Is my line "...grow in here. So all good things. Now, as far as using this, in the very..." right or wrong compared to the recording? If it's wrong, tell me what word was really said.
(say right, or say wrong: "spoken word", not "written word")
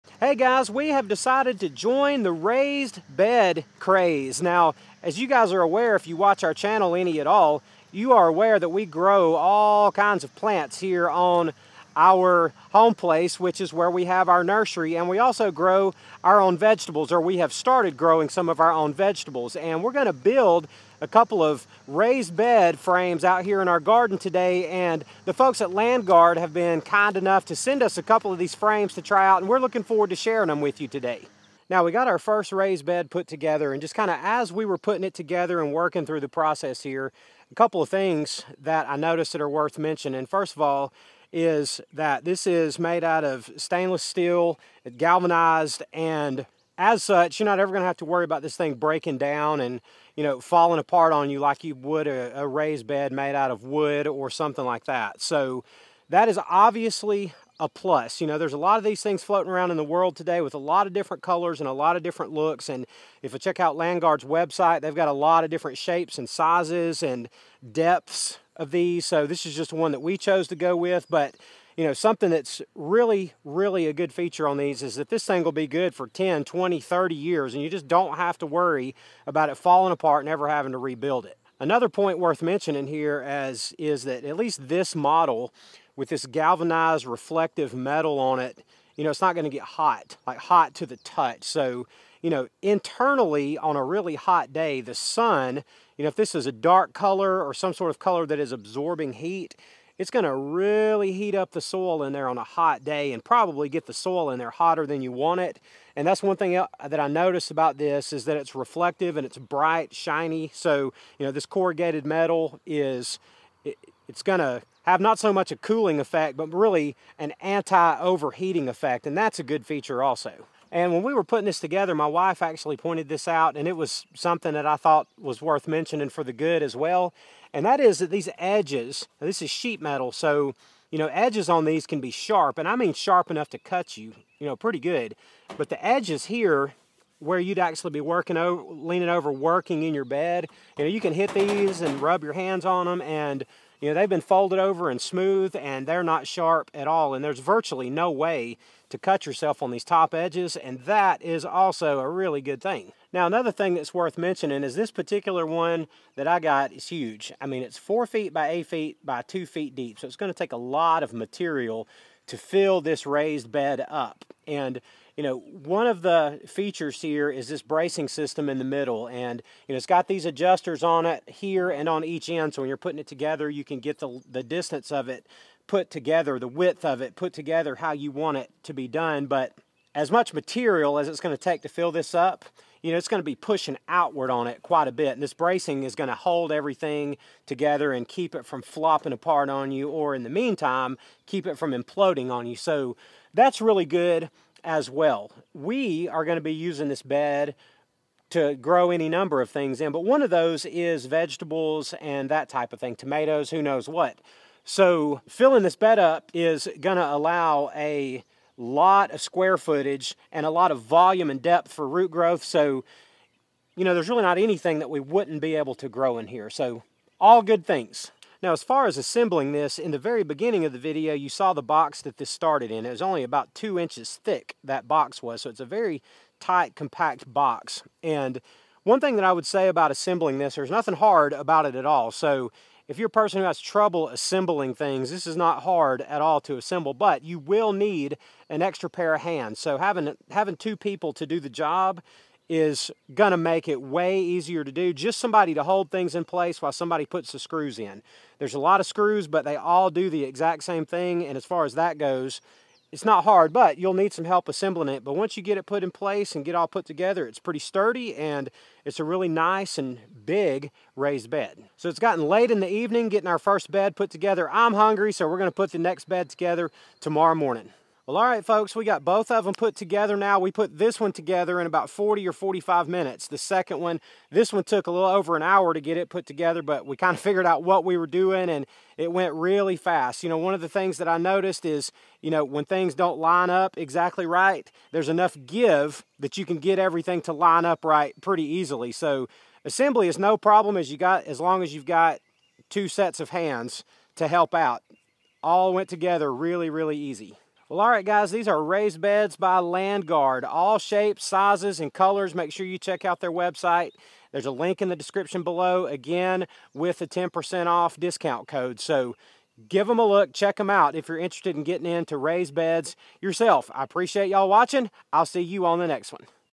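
wrong: "assembling", not "using".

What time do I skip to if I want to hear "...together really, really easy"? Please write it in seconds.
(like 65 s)
295 s.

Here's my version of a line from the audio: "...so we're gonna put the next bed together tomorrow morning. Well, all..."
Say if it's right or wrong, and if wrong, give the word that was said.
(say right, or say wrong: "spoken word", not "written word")
right.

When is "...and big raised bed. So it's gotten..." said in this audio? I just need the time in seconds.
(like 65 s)
259 s.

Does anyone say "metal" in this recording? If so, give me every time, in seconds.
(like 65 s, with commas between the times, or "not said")
87 s, 112 s, 129 s.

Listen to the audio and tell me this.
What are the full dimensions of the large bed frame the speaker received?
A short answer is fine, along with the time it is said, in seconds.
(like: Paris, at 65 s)
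4 feet by 8 feet by 2 feet, at 157 s.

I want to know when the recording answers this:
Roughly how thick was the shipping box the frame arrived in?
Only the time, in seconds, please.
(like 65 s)
223 s.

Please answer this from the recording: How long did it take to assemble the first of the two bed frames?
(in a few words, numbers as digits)
40 or 45 minutes.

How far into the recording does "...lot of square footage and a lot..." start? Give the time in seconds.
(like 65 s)
208 s.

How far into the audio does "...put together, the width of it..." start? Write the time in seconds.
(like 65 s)
175 s.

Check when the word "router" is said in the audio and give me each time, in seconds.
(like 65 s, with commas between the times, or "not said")
not said.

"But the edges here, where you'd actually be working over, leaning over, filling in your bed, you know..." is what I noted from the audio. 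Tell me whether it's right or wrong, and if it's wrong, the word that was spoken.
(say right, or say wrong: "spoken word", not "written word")
wrong: "working", not "filling".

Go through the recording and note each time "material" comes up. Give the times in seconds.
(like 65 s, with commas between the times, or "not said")
161 s, 180 s.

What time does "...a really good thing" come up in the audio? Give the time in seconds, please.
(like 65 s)
151 s.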